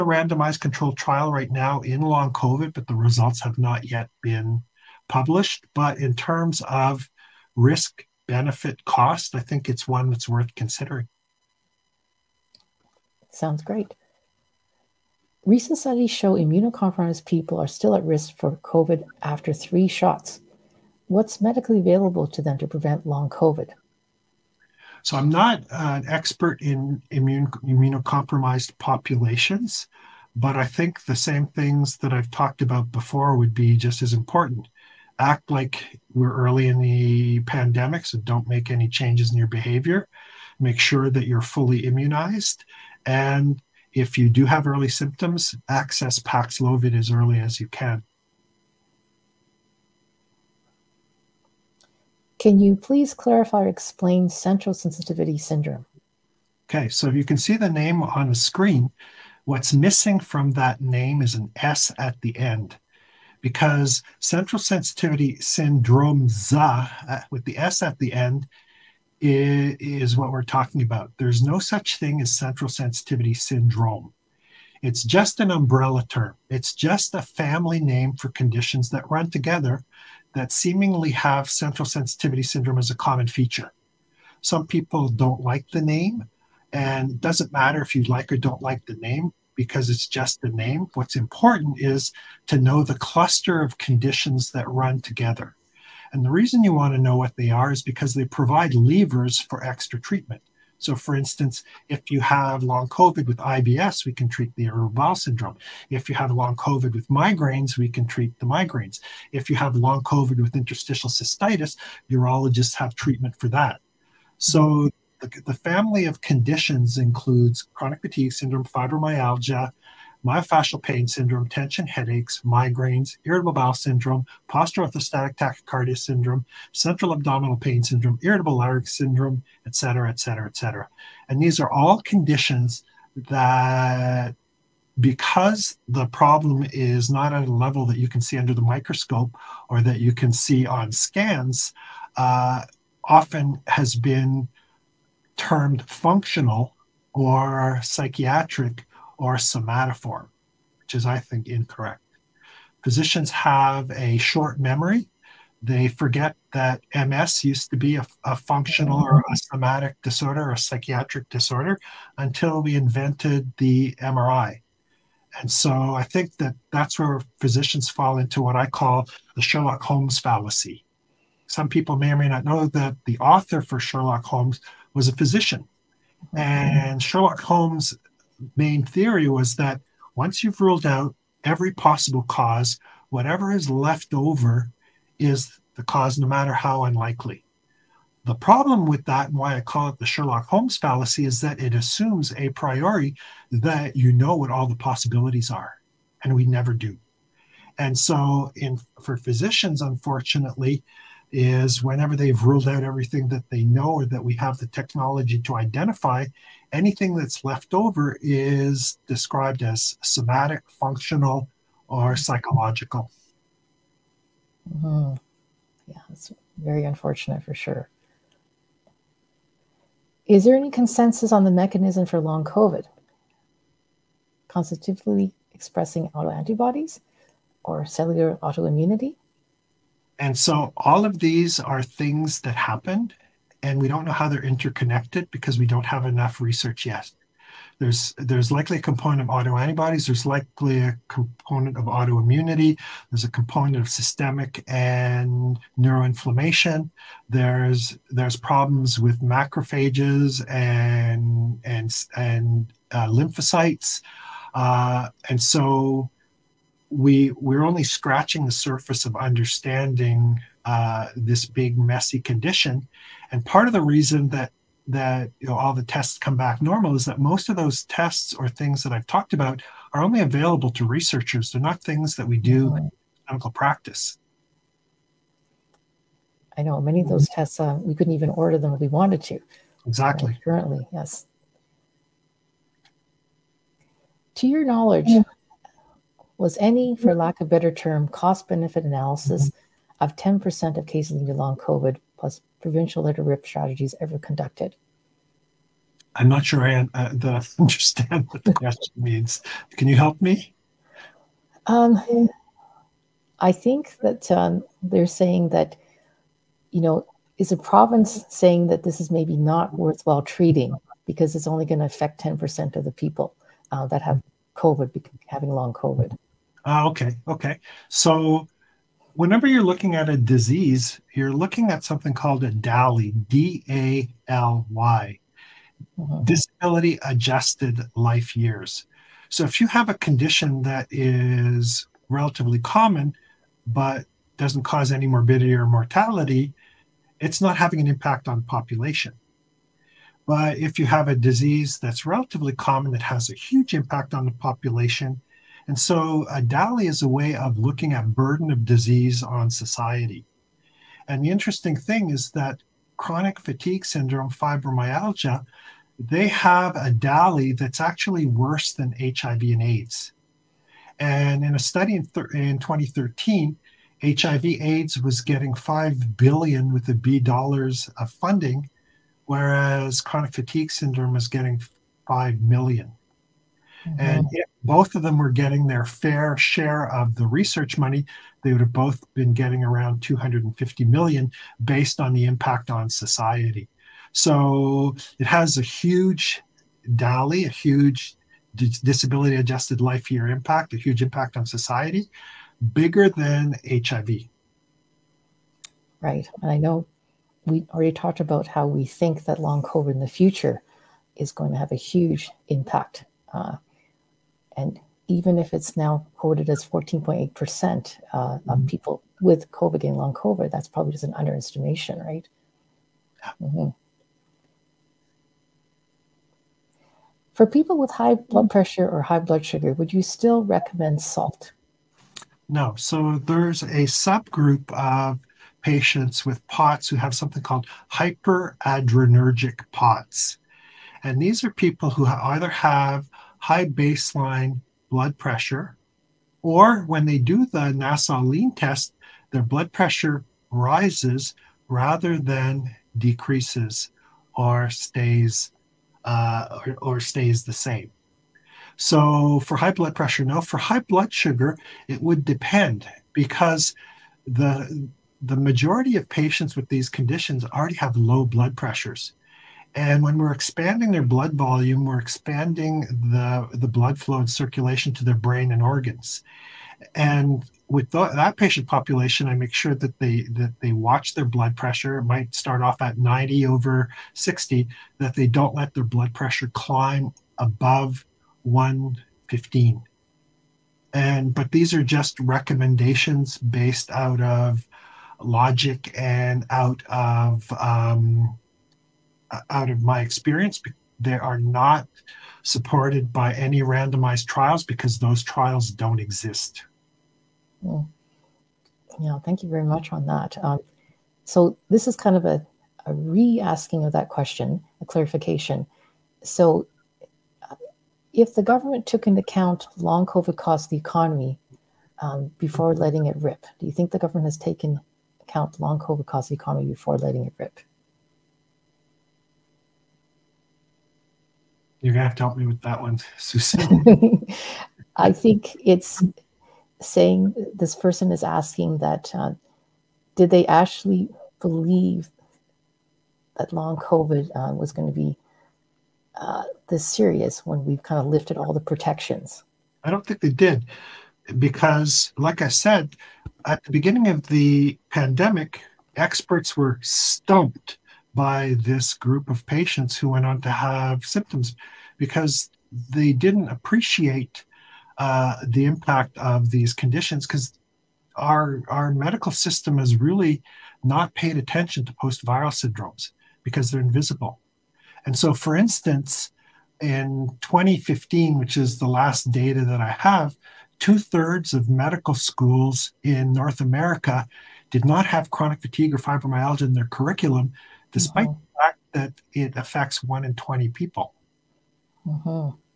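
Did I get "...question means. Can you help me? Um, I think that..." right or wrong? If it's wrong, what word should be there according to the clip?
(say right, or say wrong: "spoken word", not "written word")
right.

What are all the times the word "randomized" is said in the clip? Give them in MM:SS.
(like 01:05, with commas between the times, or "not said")
00:00, 08:13.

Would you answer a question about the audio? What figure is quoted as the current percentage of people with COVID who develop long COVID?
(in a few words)
14.8%.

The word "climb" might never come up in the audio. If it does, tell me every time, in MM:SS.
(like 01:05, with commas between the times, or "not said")
07:56.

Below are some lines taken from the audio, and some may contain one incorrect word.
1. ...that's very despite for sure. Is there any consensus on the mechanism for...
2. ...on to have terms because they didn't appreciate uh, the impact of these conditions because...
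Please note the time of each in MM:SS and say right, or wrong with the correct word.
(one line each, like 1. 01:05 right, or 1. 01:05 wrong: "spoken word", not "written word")
1. 03:36 wrong: "unfortunate", not "despite"
2. 09:10 wrong: "symptoms", not "terms".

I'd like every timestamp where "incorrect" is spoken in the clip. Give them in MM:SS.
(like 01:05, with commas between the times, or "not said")
02:31.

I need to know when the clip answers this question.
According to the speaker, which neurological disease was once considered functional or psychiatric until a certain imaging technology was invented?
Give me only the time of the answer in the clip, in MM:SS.
02:36.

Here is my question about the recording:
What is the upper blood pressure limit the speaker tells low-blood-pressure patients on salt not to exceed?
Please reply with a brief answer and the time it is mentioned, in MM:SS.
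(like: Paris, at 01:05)
115, at 07:58.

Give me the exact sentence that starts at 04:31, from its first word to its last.
They're not things that we do in clinical practice.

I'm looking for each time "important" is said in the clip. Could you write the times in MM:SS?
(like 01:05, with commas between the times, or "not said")
00:34, 01:31.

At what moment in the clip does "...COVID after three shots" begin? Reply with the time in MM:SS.
00:18.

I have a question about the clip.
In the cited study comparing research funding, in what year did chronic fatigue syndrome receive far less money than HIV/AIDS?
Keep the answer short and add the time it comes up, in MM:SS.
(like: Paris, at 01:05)
2013, at 06:02.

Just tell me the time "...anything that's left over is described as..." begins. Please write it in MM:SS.
03:26.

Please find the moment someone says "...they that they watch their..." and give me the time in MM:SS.
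07:49.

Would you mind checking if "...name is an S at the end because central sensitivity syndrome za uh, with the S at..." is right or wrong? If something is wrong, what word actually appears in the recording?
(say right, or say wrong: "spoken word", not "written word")
right.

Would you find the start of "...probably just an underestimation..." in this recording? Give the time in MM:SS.
06:50.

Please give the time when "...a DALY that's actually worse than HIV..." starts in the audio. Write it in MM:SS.
05:56.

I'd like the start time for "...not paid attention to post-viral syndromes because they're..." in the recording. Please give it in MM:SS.
09:20.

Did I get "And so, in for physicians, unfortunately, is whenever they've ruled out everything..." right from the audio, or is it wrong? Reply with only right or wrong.
right.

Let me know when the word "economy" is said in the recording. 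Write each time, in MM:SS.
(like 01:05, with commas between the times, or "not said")
08:30, 08:36.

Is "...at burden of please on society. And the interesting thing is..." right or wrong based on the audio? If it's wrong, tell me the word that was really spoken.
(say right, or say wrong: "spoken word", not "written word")
wrong: "disease", not "please".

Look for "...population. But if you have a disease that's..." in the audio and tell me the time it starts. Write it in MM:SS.
05:38.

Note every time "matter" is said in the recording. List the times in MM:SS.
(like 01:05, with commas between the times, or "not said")
01:27, 03:06.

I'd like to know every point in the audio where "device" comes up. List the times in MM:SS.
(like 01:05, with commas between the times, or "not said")
not said.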